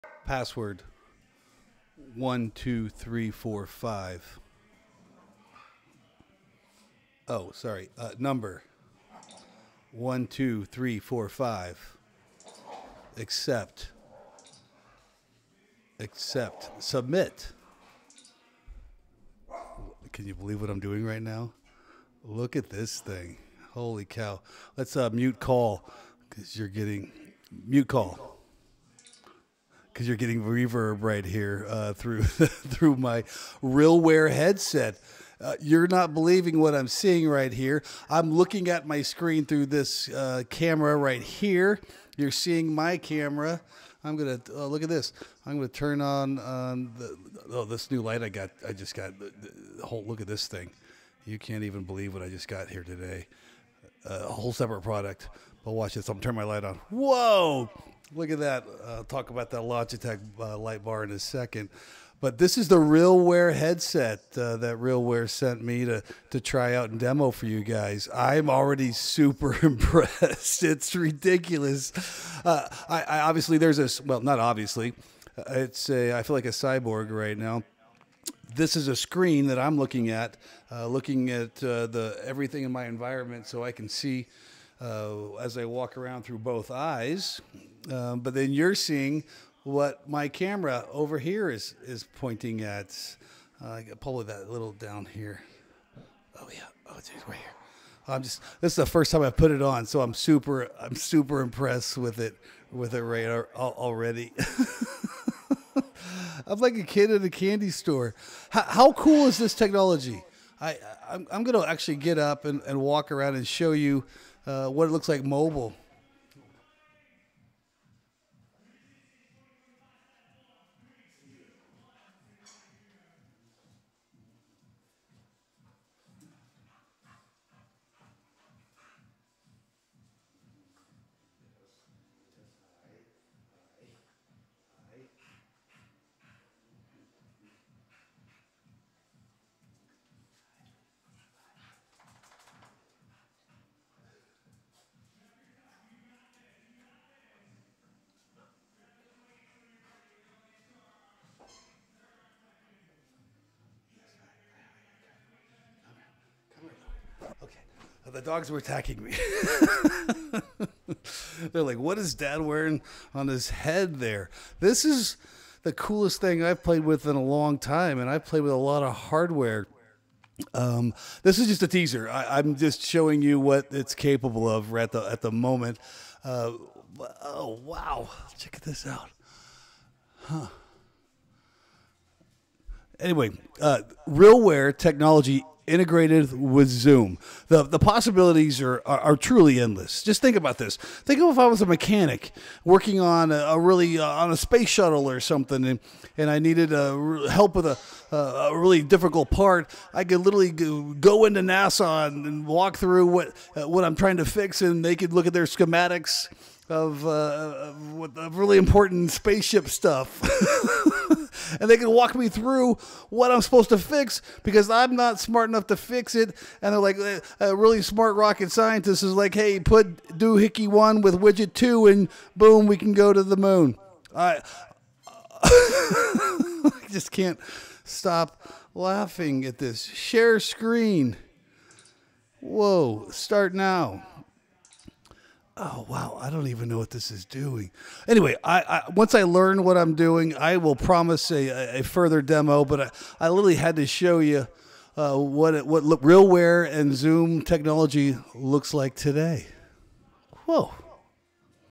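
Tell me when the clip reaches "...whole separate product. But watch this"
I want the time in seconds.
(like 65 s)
54 s.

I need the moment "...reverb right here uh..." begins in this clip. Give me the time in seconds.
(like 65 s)
30 s.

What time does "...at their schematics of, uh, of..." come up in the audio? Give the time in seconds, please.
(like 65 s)
205 s.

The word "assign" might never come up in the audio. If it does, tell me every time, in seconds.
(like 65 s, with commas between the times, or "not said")
not said.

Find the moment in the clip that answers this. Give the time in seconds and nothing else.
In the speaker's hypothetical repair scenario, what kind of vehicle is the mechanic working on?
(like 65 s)
194 s.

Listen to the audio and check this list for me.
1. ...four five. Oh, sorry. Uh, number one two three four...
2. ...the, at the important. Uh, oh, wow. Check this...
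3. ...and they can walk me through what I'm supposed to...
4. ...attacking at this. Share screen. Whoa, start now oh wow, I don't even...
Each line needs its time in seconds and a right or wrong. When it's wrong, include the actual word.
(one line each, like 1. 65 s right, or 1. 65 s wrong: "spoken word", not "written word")
1. 3 s right
2. 174 s wrong: "moment", not "important"
3. 211 s right
4. 228 s wrong: "laughing", not "attacking".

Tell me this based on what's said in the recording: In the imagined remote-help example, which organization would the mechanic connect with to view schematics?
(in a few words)
NASA.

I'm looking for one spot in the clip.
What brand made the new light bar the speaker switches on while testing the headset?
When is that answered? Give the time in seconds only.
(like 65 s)
59 s.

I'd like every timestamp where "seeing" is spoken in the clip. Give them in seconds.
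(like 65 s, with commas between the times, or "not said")
36 s, 42 s, 88 s.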